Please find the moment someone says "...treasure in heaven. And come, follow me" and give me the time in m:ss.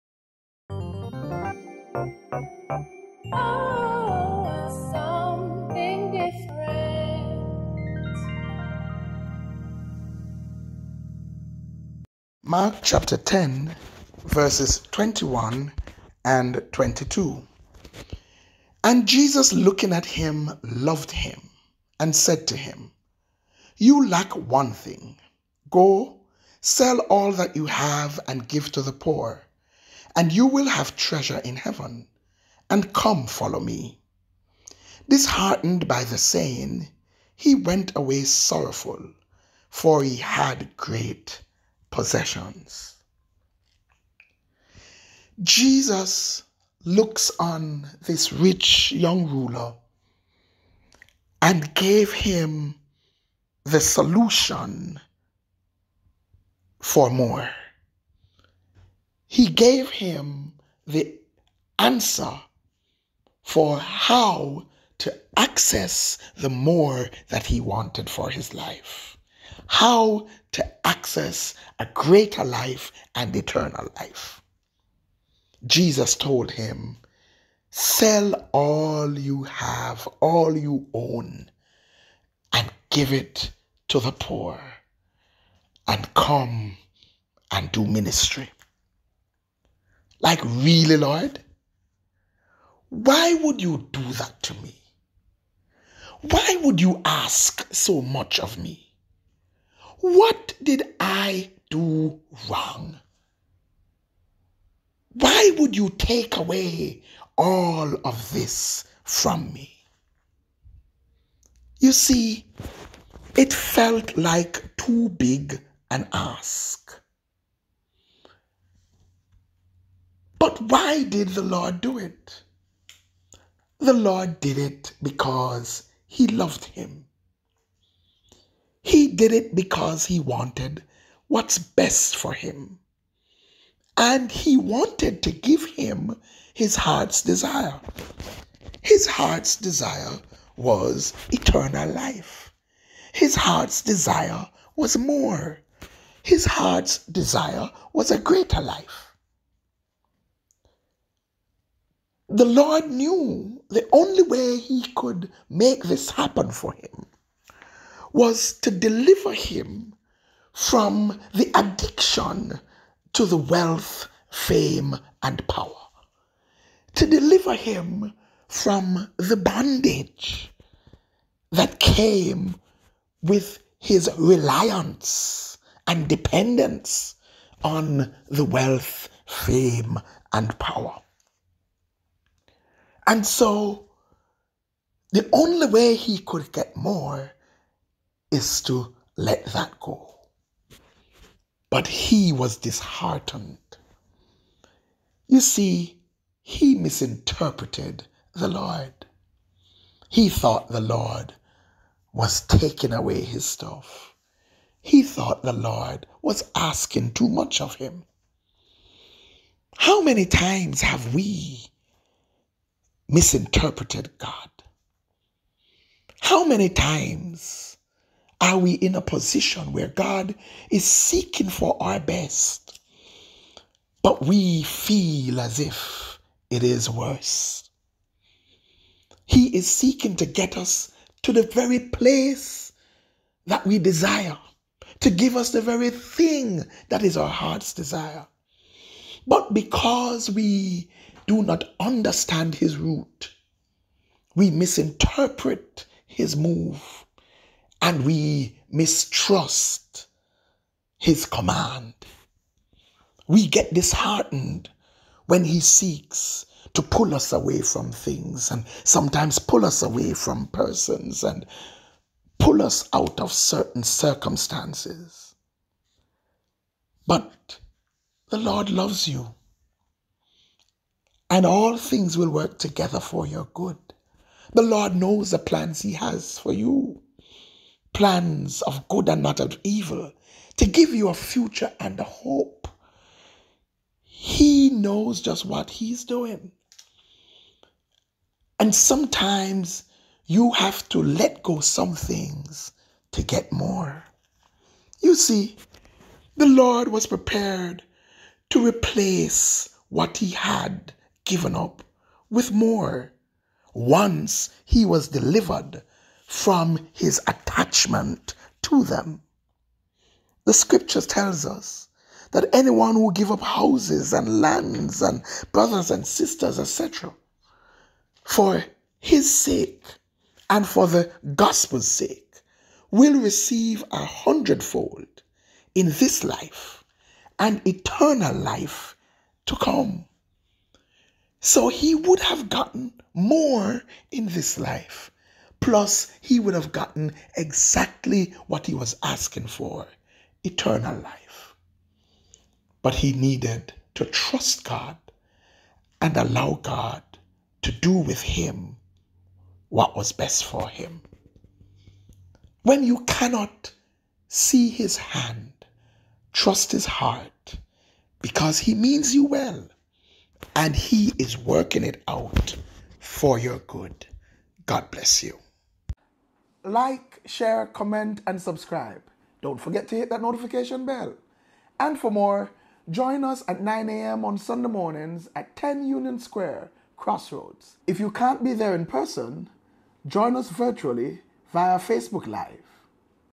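0:30.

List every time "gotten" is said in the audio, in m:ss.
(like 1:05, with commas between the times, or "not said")
5:32, 5:36.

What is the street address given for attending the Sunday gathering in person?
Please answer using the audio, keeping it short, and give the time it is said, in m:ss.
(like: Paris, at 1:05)
10 Union Square, at 6:15.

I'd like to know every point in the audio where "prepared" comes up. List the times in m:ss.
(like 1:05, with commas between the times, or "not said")
4:57.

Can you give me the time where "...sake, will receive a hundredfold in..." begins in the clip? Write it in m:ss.
5:21.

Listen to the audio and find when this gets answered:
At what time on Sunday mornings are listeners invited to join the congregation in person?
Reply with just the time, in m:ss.
6:13.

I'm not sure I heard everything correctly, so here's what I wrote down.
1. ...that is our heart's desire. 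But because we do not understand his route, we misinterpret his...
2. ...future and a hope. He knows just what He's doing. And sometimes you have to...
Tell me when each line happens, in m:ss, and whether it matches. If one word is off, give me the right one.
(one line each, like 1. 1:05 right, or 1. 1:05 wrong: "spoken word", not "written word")
1. 3:56 right
2. 4:41 right.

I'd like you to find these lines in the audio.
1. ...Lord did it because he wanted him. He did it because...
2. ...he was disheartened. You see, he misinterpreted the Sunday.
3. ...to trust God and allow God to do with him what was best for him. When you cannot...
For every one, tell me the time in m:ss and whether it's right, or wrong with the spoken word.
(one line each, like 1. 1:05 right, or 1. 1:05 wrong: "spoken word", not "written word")
1. 2:03 wrong: "loved", not "wanted"
2. 3:11 wrong: "Lord", not "Sunday"
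3. 5:43 right.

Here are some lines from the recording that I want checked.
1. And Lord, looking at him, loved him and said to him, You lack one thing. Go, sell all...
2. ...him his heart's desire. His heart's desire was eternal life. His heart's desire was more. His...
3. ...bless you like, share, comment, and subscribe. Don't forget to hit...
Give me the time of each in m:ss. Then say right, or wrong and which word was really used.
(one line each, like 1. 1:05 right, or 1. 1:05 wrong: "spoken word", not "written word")
1. 0:18 wrong: "Jesus", not "Lord"
2. 2:15 right
3. 6:04 right.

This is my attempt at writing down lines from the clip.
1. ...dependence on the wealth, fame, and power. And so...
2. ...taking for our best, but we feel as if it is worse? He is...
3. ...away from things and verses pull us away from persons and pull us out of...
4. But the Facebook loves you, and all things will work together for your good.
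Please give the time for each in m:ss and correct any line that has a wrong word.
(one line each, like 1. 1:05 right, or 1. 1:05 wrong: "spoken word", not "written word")
1. 2:56 right
2. 3:40 wrong: "seeking", not "taking"
3. 4:17 wrong: "sometimes", not "verses"
4. 4:27 wrong: "Lord", not "Facebook".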